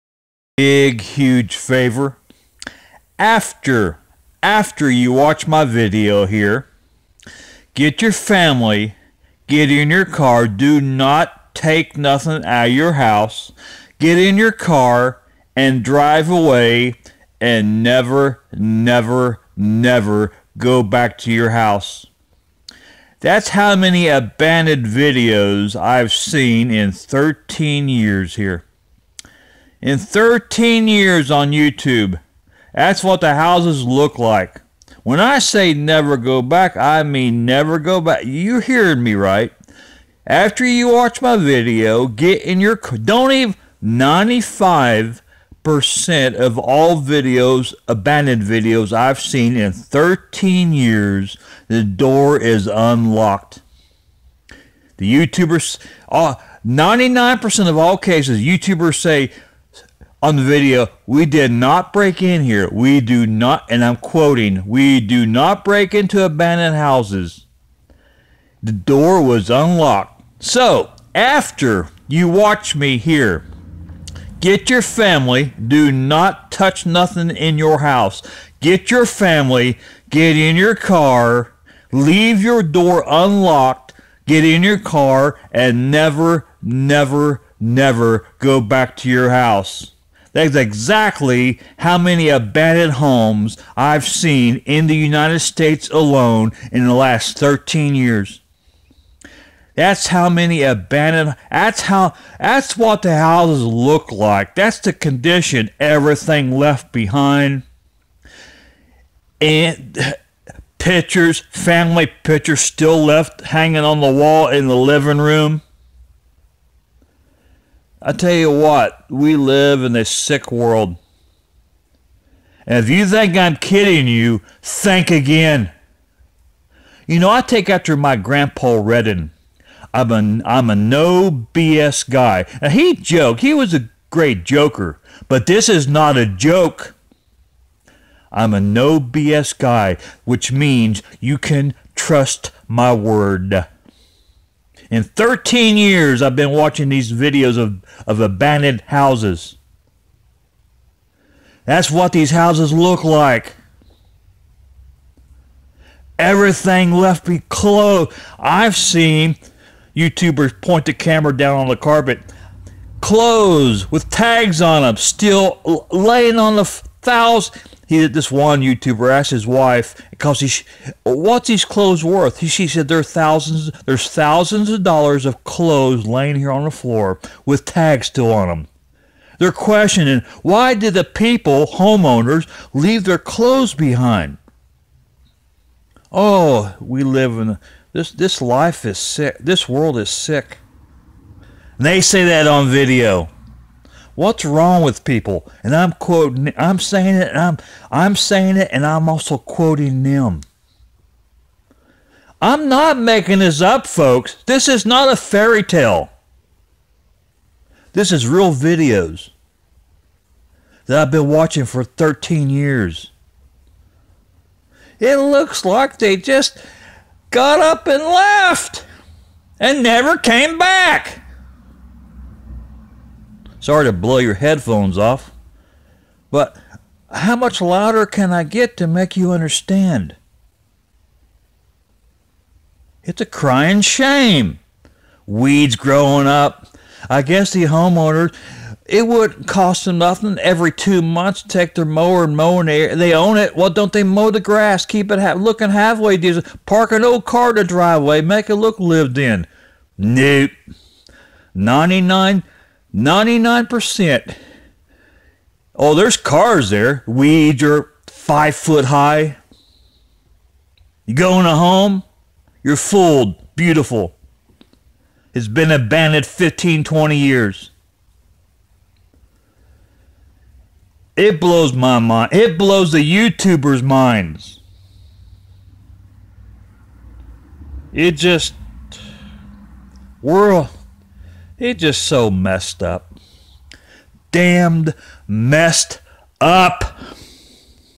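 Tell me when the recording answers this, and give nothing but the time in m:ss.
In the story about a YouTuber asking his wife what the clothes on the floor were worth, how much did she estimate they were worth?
2:54.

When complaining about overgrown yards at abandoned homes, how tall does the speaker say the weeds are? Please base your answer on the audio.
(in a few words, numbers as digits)
5 feet.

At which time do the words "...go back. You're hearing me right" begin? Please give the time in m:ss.
0:37.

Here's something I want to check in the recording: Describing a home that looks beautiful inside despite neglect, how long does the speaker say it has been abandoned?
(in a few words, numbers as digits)
15 to 20 years.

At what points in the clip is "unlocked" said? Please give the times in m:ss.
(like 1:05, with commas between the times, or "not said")
0:52, 1:09, 1:23.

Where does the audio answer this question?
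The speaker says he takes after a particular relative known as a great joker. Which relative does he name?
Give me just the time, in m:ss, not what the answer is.
2:08.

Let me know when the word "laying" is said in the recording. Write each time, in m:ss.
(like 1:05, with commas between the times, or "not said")
2:45, 2:56.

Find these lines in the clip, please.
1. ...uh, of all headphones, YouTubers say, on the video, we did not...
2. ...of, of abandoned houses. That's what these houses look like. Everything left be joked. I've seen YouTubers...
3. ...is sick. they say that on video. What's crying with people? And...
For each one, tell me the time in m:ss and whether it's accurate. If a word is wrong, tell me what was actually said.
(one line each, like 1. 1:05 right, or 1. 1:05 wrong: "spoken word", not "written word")
1. 0:57 wrong: "cases", not "headphones"
2. 2:27 wrong: "closed", not "joked"
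3. 3:09 wrong: "wrong", not "crying".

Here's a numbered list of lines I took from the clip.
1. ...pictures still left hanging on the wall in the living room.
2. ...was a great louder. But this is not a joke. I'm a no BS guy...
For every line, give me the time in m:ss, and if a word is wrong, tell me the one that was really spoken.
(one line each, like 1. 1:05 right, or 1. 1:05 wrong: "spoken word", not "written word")
1. 1:52 right
2. 2:13 wrong: "joker", not "louder".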